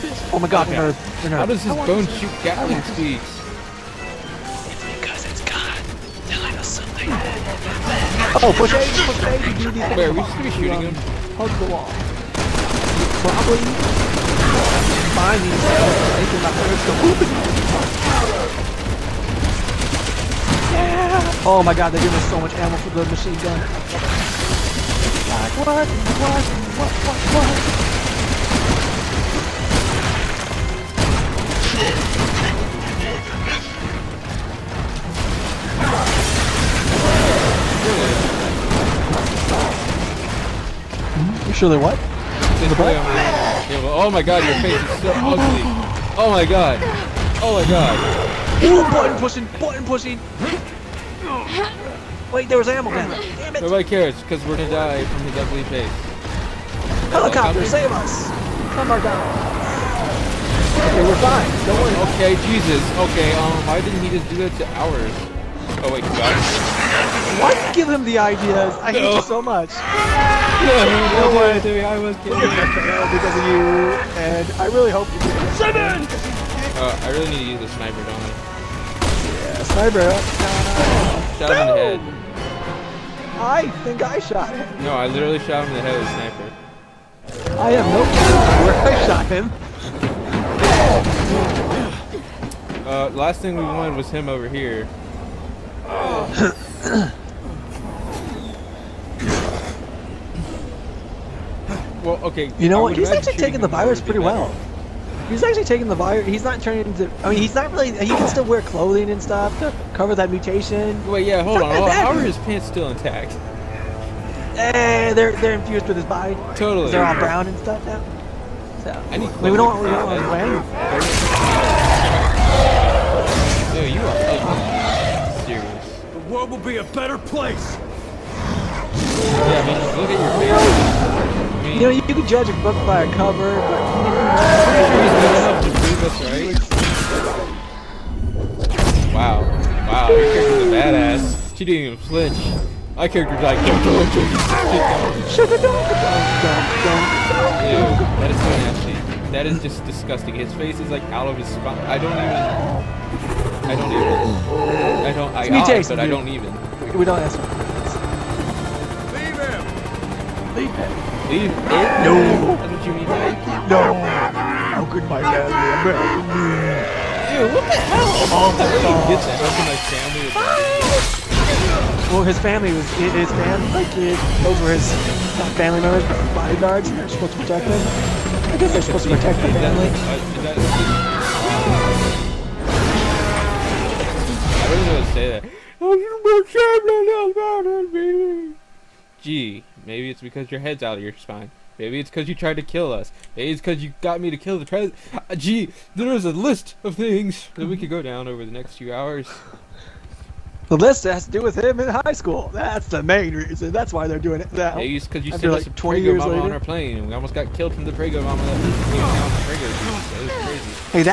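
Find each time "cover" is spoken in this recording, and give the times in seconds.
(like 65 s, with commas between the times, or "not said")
109 s, 133 s.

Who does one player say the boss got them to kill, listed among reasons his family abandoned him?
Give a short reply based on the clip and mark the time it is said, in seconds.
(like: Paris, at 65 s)
The president, at 194 s.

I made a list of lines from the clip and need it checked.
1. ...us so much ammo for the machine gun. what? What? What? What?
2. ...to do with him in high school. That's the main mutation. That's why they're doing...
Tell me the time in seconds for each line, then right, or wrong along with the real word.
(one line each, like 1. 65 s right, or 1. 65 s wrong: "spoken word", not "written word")
1. 22 s right
2. 201 s wrong: "reason", not "mutation".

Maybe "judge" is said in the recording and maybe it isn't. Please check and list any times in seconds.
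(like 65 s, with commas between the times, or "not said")
132 s.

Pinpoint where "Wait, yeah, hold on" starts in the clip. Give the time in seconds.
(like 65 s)
111 s.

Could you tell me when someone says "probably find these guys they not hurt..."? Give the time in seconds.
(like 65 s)
13 s.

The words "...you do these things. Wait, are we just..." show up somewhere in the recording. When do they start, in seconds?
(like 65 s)
9 s.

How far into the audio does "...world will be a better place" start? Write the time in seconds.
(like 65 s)
126 s.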